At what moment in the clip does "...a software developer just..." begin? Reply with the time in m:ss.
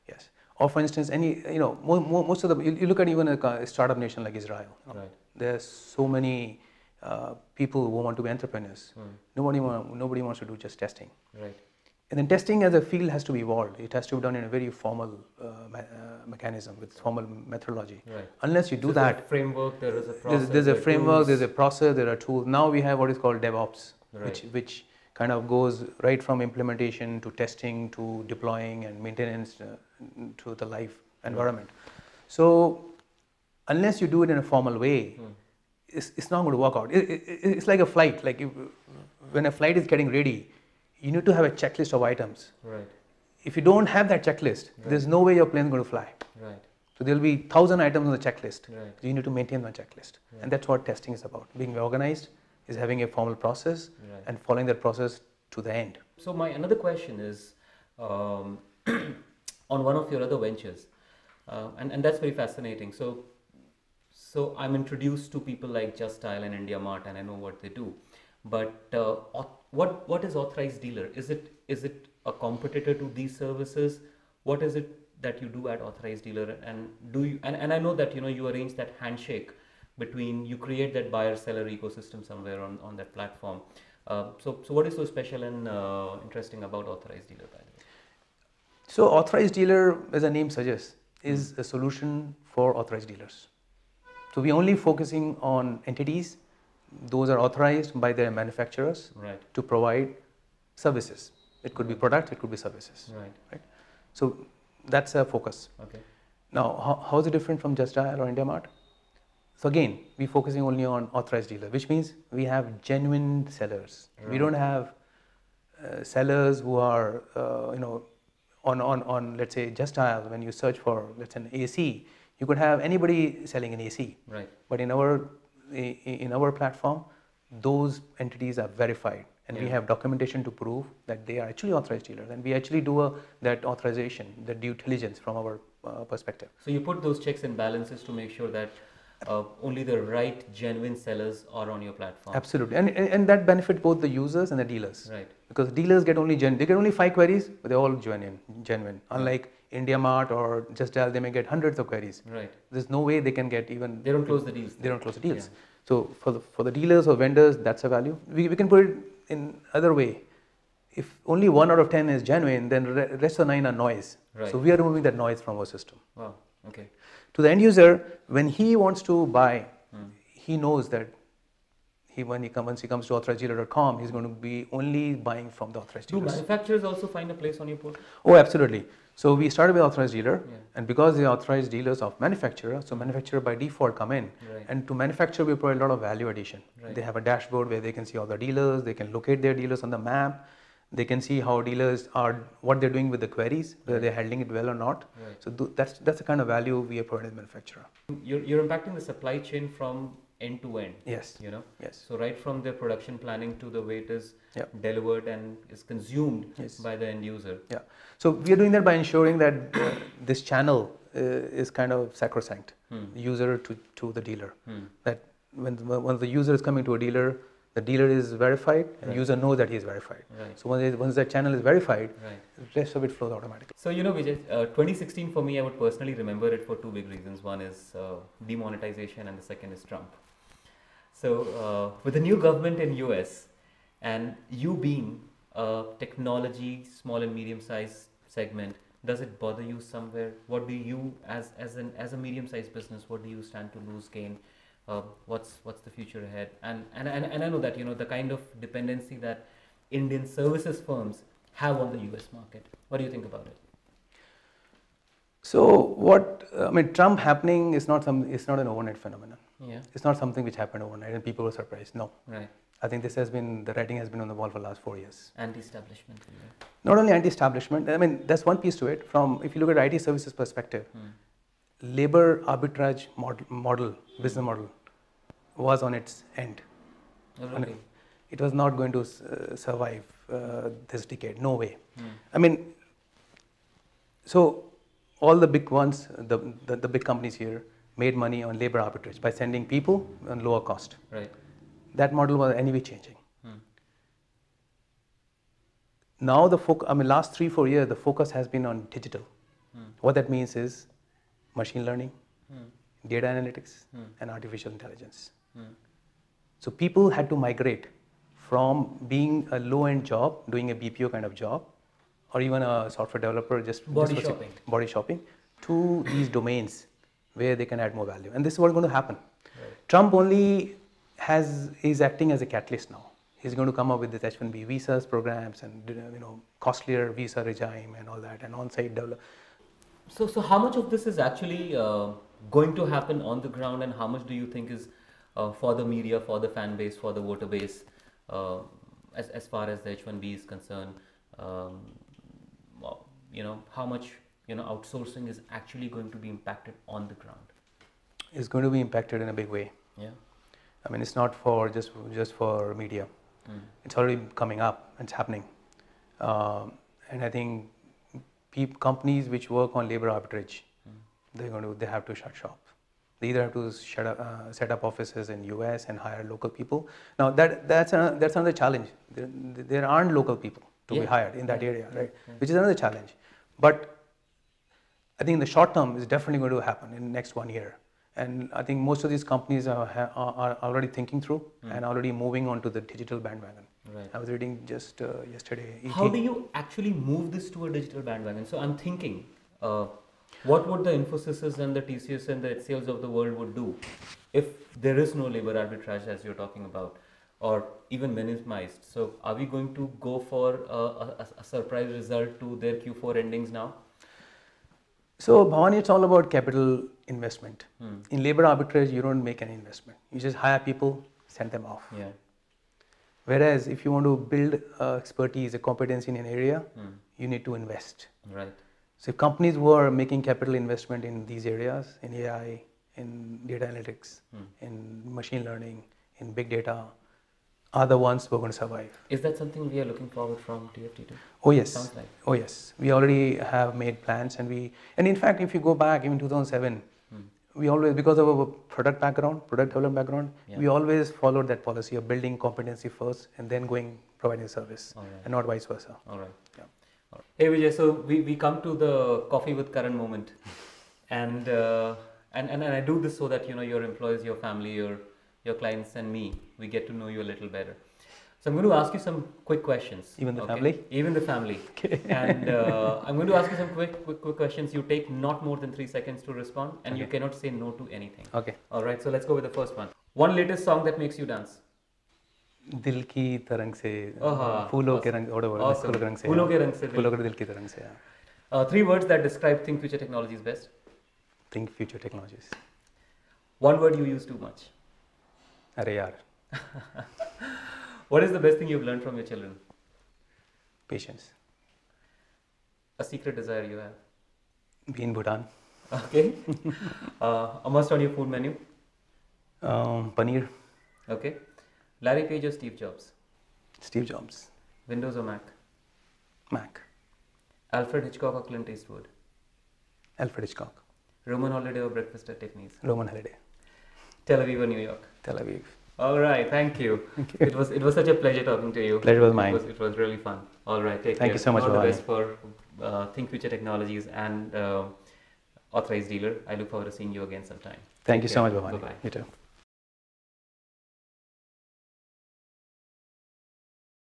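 5:12.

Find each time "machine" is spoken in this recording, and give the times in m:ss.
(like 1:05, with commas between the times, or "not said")
5:01, 7:05.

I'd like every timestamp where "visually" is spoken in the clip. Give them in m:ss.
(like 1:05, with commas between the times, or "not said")
not said.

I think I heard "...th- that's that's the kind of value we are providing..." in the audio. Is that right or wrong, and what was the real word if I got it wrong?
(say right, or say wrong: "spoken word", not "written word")
right.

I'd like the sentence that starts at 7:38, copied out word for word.
So I'm going to ask you some quick questions.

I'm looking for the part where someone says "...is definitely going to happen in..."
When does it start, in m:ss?
6:15.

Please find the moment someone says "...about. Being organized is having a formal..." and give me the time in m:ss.
0:51.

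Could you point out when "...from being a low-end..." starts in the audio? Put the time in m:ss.
5:08.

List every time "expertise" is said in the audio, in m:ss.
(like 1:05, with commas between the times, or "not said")
6:54.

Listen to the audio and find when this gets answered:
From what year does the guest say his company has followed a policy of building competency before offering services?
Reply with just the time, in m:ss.
7:16.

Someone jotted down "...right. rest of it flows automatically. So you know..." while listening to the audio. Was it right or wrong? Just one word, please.
right.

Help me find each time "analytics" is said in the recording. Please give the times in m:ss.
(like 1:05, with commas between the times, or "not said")
5:03, 7:03.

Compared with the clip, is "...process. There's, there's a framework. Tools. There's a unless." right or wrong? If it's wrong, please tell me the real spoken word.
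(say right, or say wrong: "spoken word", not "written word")
wrong: "process", not "unless".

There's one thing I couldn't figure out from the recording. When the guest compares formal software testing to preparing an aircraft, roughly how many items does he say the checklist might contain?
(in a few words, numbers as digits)
1000.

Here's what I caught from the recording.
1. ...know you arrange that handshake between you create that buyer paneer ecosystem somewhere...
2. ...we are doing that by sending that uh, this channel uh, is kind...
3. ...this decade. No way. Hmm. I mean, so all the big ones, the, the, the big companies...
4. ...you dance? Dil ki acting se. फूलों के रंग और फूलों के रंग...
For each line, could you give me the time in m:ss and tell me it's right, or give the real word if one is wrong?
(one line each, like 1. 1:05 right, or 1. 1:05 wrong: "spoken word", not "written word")
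1. 1:18 wrong: "seller", not "paneer"
2. 3:28 wrong: "ensuring", not "sending"
3. 4:40 right
4. 7:51 wrong: "tarang", not "acting".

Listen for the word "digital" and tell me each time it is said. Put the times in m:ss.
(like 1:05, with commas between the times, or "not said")
4:58, 6:22, 6:27.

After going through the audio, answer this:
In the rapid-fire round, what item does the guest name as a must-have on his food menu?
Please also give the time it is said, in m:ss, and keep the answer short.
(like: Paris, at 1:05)
Paneer, at 8:20.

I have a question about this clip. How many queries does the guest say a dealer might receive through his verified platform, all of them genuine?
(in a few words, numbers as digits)
5.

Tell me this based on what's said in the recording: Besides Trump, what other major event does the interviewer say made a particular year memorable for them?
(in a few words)
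Demonetization.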